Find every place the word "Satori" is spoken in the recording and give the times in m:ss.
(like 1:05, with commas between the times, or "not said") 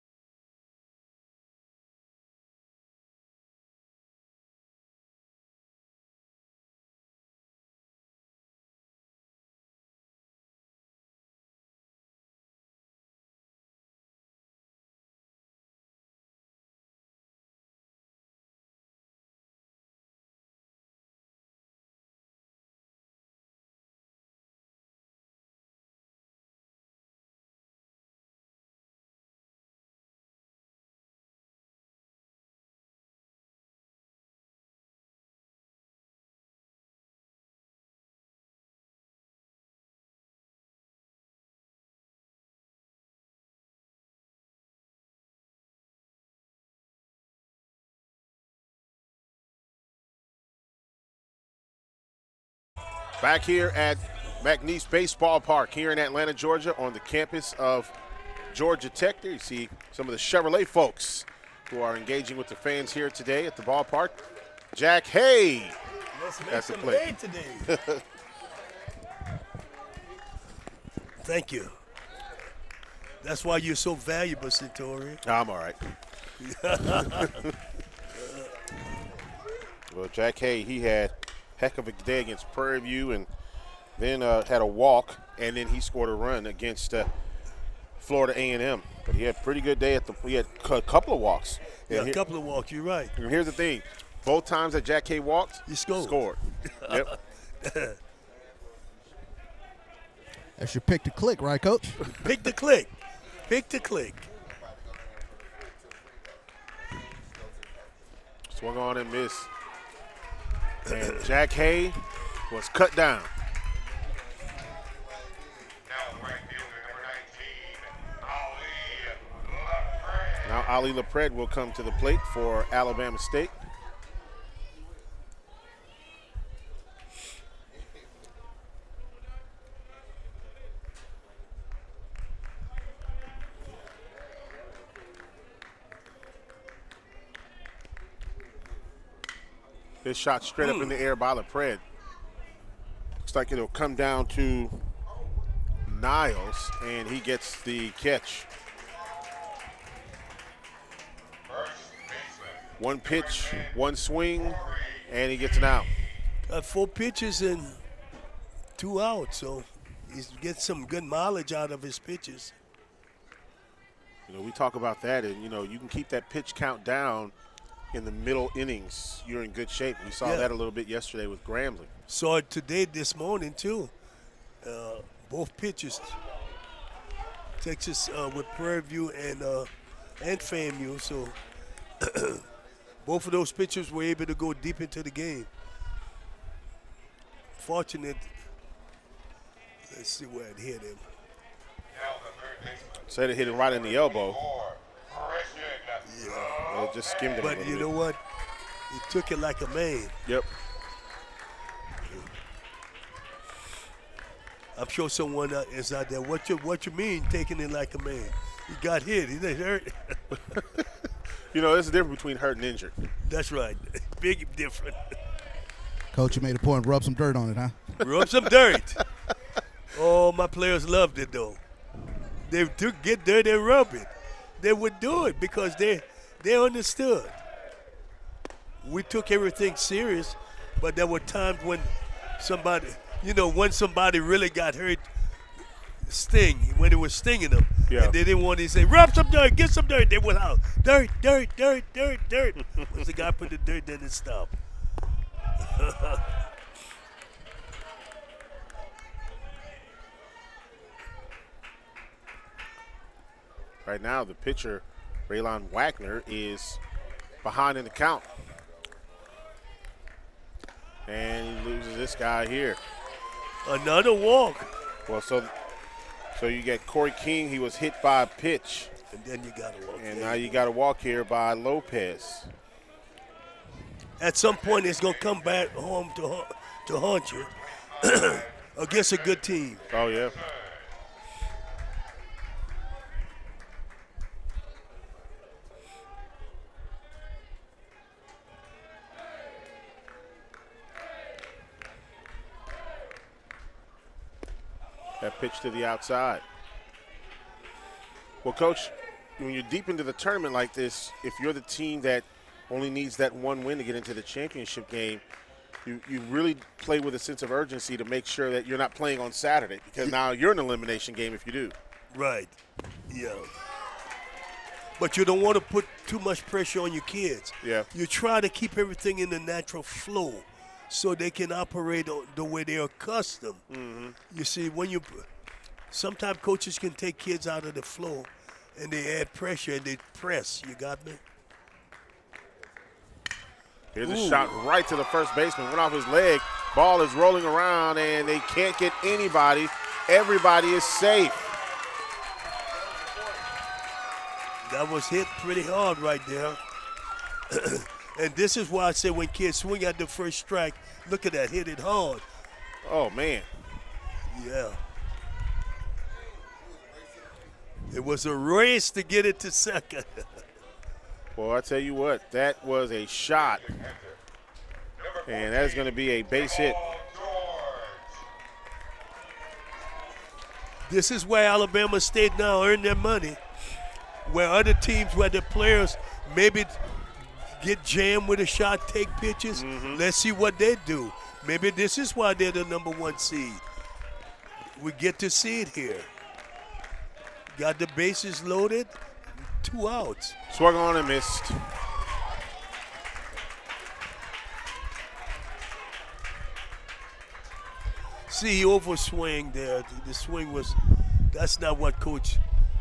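1:14.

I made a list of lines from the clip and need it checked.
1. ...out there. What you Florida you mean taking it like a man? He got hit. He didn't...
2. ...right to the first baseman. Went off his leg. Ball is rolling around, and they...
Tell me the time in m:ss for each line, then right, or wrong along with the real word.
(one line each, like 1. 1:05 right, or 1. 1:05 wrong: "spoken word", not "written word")
1. 3:25 wrong: "What", not "Florida"
2. 5:34 right.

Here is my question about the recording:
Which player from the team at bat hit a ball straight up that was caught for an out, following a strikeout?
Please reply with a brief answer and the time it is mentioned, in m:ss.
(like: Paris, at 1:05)
Ali LaPred, at 2:00.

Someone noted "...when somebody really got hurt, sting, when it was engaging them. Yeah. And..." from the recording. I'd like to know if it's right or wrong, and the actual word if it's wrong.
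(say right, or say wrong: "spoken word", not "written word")
wrong: "stinging", not "engaging".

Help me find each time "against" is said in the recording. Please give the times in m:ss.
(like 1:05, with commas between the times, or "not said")
1:22, 1:26, 4:38.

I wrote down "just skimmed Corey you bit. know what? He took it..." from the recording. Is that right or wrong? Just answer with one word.
wrong.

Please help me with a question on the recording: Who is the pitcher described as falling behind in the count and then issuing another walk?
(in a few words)
Raylon Wagner.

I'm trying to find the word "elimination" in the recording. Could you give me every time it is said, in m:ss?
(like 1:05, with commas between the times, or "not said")
5:10.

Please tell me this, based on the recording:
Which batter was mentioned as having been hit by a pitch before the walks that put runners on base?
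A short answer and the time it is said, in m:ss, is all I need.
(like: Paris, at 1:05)
Corey King, at 4:26.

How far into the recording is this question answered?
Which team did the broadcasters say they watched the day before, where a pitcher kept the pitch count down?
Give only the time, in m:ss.
2:51.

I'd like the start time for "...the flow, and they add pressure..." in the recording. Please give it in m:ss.
5:27.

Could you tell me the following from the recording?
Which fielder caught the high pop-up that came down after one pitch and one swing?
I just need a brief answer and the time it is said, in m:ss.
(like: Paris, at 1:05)
Niles, at 2:26.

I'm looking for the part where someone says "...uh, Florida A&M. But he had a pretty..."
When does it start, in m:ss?
1:26.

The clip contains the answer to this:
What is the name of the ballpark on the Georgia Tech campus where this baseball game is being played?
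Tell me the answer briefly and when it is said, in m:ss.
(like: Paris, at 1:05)
Mac Nease Baseball Park, at 0:54.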